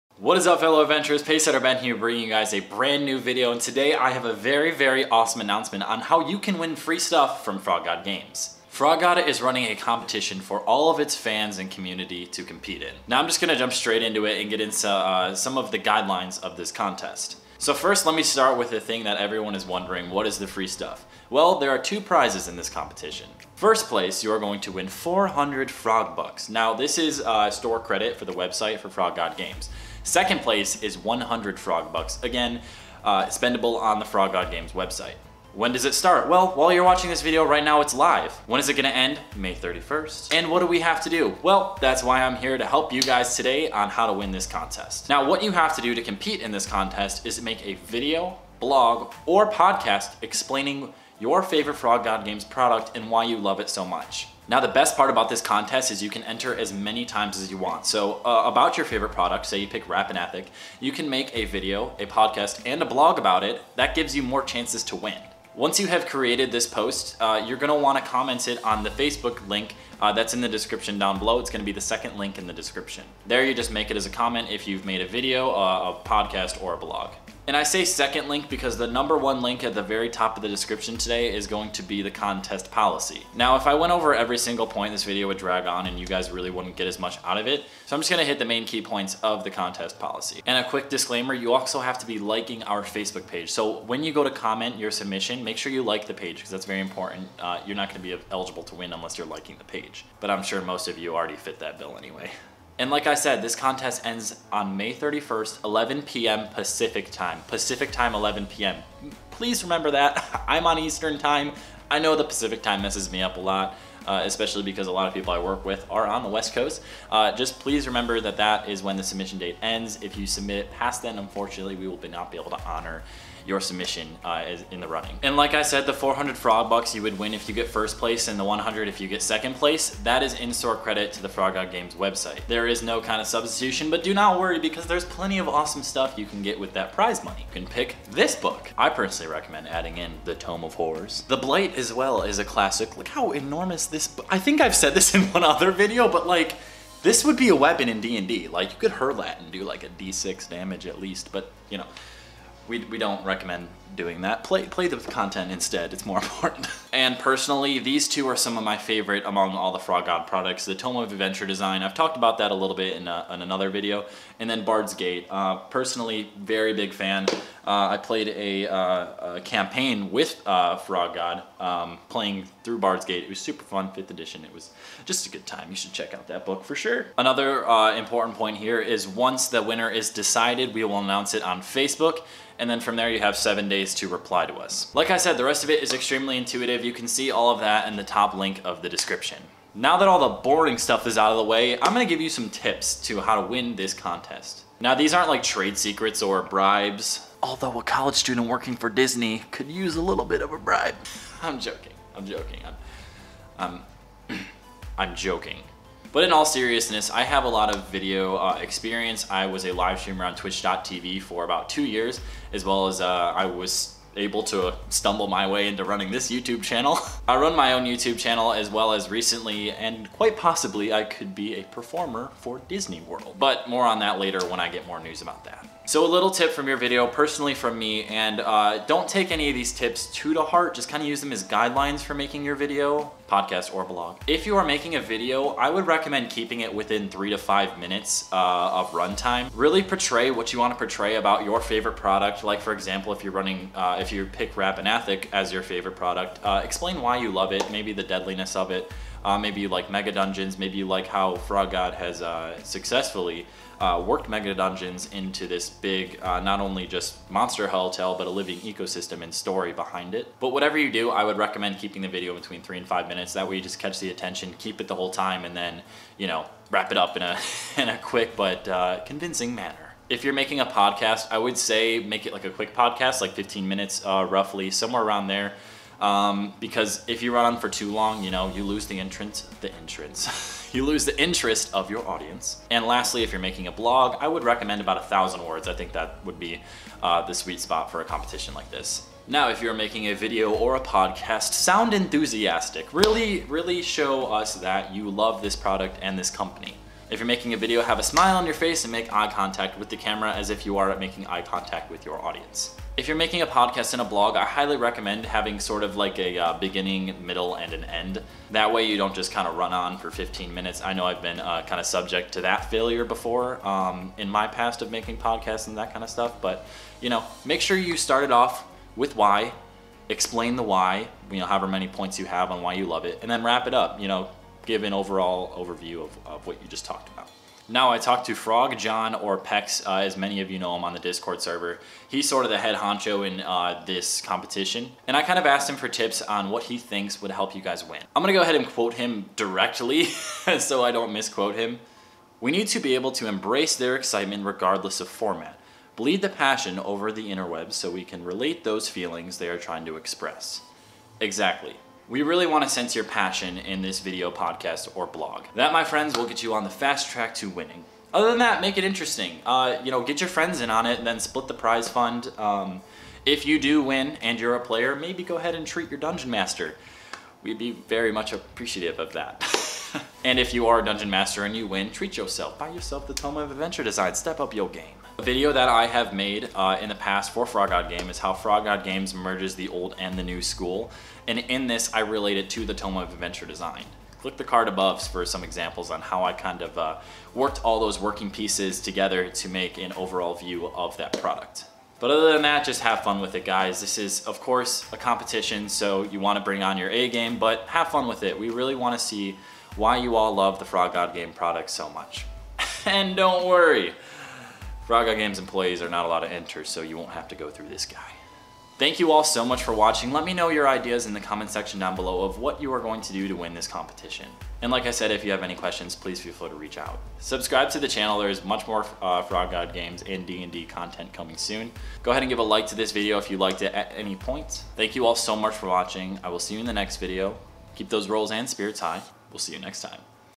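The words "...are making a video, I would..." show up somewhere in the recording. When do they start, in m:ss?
3:54.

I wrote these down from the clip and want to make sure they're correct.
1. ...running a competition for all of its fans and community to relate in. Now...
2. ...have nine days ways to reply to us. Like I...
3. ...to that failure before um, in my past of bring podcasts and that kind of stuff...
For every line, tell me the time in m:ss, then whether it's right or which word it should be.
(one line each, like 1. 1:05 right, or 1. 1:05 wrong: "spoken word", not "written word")
1. 0:09 wrong: "compete", not "relate"
2. 3:03 wrong: "seven", not "nine"
3. 5:12 wrong: "making", not "bring".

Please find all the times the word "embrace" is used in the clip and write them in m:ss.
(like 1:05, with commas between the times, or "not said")
5:43.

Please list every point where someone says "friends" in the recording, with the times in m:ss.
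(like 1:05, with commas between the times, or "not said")
5:55, 6:00.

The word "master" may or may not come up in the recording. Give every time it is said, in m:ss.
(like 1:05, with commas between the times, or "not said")
6:06, 6:11.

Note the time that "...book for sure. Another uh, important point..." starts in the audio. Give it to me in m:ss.
2:56.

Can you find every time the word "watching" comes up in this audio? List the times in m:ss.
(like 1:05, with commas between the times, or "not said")
0:36, 6:49, 7:05.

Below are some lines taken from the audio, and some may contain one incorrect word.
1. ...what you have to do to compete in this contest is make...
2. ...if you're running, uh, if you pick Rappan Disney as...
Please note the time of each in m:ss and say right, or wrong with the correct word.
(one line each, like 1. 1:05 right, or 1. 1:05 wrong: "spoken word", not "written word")
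1. 0:45 right
2. 4:03 wrong: "Athuk", not "Disney".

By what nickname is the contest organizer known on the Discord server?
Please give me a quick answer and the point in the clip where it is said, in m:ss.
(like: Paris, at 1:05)
Pex, at 5:29.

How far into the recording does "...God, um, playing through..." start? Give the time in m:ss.
2:51.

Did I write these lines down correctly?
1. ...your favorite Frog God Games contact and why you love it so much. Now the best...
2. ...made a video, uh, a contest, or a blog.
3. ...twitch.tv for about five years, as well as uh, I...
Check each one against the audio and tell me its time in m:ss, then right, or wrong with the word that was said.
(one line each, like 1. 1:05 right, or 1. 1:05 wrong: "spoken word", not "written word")
1. 0:51 wrong: "product", not "contact"
2. 1:14 wrong: "podcast", not "contest"
3. 3:30 wrong: "two", not "five".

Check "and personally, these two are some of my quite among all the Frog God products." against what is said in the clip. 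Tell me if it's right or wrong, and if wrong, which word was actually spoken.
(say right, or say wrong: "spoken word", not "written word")
wrong: "favorite", not "quite".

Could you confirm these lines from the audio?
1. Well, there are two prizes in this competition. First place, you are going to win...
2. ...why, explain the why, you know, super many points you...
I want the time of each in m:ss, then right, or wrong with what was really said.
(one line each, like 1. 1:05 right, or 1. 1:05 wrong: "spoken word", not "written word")
1. 0:21 right
2. 5:19 wrong: "however", not "super".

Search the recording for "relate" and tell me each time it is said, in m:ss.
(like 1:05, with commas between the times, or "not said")
5:48, 6:22.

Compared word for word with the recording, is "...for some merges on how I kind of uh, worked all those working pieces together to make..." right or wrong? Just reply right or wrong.
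wrong.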